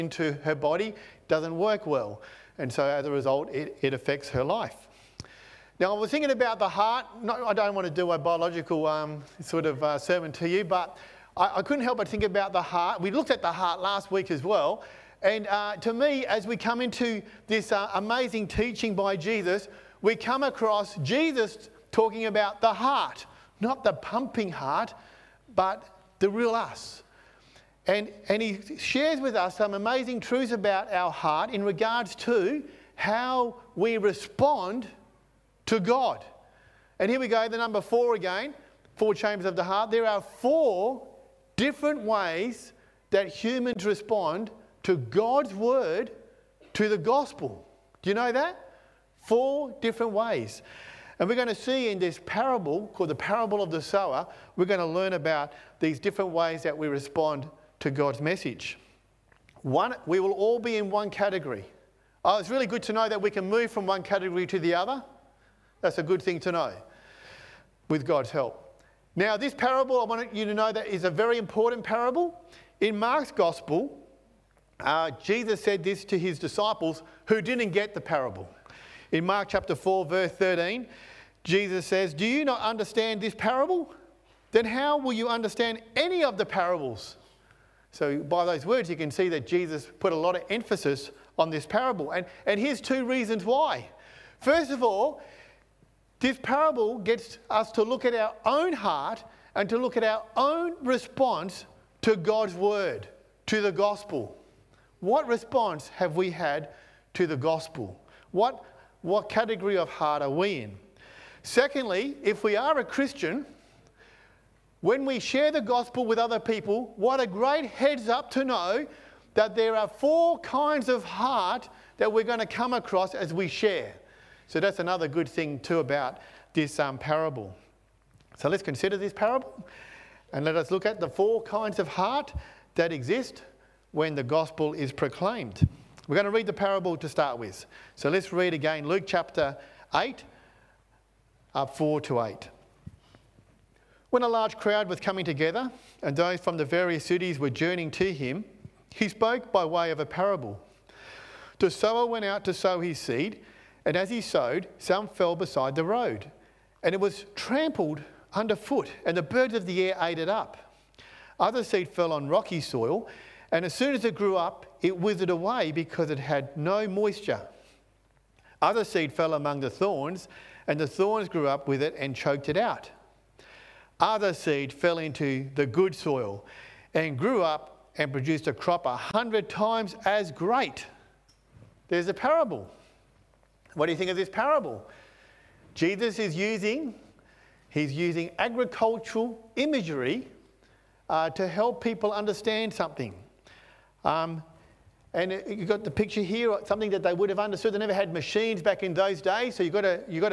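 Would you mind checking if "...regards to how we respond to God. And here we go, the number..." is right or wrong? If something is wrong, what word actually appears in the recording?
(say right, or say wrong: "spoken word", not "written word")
right.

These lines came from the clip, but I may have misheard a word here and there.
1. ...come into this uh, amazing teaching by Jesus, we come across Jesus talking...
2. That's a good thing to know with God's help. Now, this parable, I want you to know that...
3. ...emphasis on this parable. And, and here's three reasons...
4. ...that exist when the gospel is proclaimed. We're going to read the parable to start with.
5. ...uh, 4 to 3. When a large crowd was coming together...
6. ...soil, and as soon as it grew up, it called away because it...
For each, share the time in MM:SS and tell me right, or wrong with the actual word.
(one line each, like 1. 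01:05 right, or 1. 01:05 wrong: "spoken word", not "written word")
1. 00:16 right
2. 01:05 right
3. 01:30 wrong: "two", not "three"
4. 02:12 right
5. 02:21 wrong: "8", not "3"
6. 02:42 wrong: "withered", not "called".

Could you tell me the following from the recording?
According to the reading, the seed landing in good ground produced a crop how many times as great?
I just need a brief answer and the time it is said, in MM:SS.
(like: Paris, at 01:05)
100, at 02:58.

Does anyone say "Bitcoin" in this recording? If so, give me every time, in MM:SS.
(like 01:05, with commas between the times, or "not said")
not said.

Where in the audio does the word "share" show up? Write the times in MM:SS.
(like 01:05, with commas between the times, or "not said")
00:28, 01:55, 02:03.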